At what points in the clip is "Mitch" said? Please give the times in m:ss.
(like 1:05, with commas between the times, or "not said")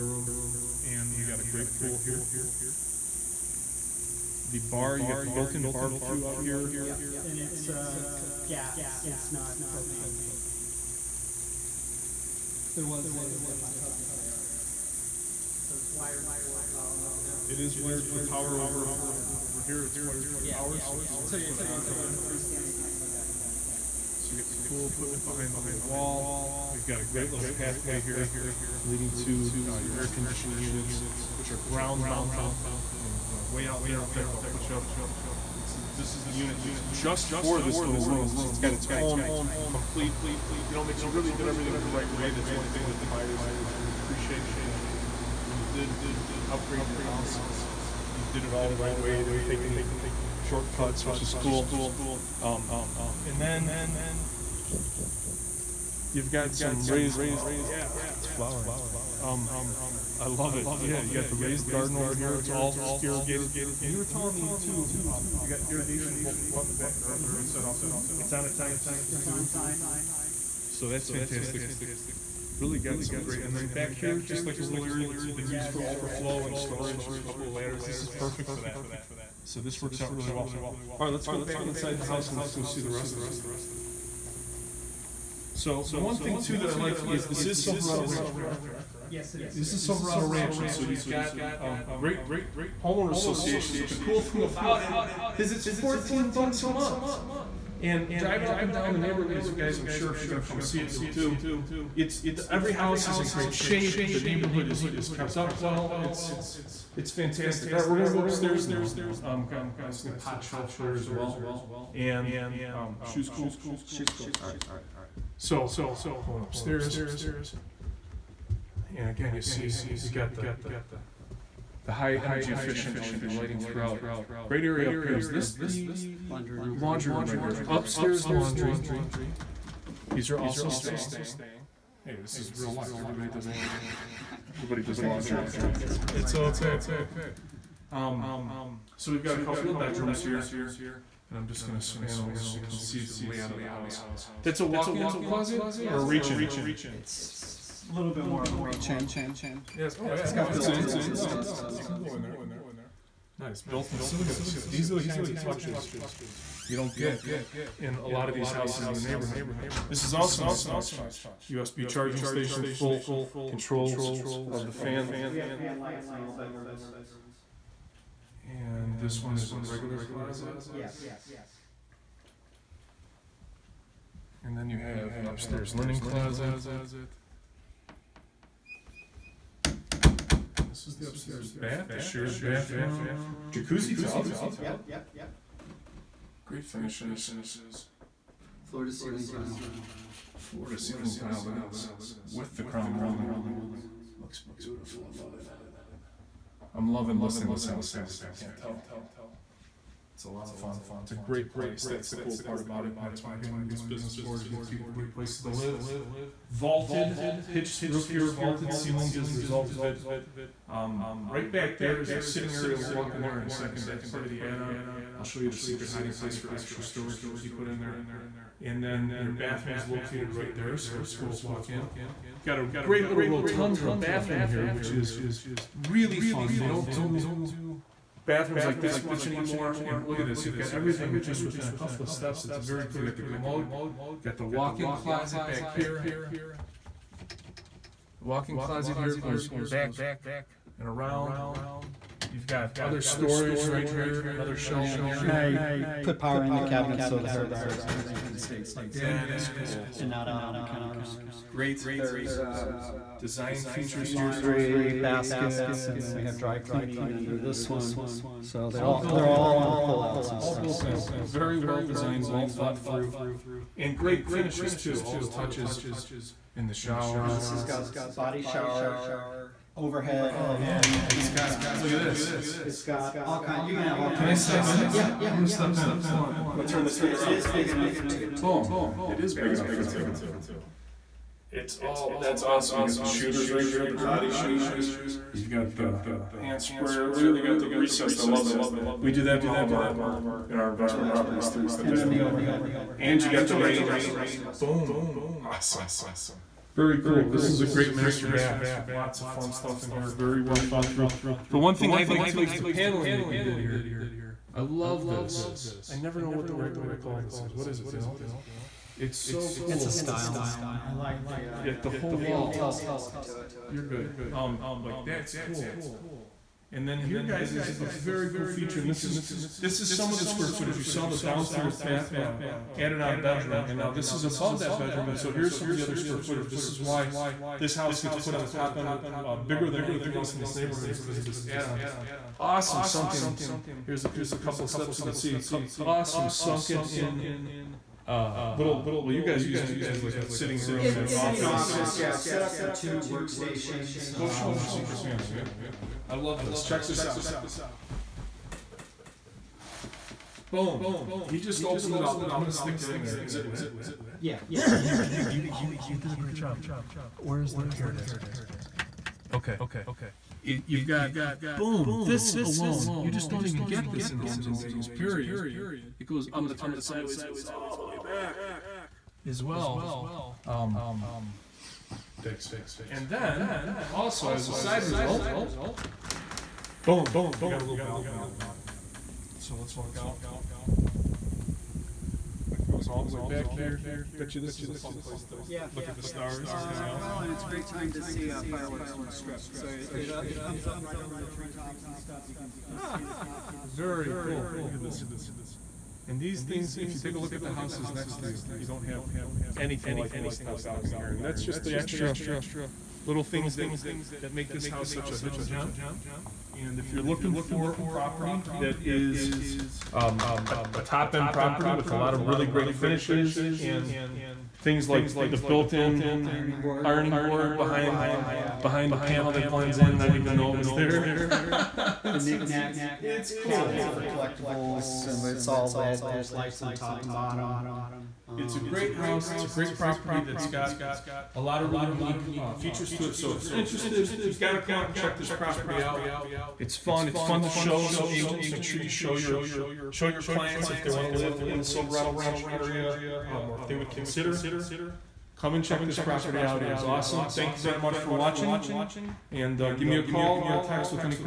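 0:40.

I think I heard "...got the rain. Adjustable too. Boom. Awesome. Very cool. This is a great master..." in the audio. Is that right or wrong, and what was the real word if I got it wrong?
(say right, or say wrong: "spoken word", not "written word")
right.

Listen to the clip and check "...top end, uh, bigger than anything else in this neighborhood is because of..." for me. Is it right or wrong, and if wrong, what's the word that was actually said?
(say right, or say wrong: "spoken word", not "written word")
right.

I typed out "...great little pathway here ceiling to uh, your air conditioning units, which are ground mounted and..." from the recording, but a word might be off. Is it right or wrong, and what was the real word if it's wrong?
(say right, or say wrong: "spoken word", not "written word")
wrong: "leading", not "ceiling".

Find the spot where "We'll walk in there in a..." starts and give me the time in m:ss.
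3:32.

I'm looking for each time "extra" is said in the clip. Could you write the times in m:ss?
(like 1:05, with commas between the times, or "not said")
3:36, 6:41.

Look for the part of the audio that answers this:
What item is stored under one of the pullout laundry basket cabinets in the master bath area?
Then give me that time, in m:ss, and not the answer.
4:16.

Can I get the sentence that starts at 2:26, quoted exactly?
It's a little bit more of a reach-in.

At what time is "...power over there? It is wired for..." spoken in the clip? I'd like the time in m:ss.
0:16.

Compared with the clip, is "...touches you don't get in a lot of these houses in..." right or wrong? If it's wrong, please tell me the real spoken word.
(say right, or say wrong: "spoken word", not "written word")
right.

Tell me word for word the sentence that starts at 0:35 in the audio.
It's, this is the unit that's just for this little room, so it's got its right.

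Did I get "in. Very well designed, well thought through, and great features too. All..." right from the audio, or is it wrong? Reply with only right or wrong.
wrong.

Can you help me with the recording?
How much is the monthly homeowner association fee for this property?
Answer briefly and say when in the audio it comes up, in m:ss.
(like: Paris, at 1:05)
$14, at 1:35.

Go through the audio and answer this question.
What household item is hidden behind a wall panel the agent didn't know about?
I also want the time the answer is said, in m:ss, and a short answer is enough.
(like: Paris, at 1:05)
Ironing board, at 6:55.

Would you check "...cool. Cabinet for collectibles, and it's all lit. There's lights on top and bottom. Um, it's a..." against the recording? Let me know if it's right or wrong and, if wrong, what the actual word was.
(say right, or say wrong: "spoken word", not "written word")
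right.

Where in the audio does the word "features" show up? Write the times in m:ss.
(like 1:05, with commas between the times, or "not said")
4:13, 5:18, 7:12.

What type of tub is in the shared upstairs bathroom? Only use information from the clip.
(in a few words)
Jacuzzi tub.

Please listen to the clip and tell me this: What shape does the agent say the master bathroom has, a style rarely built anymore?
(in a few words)
Rotunda.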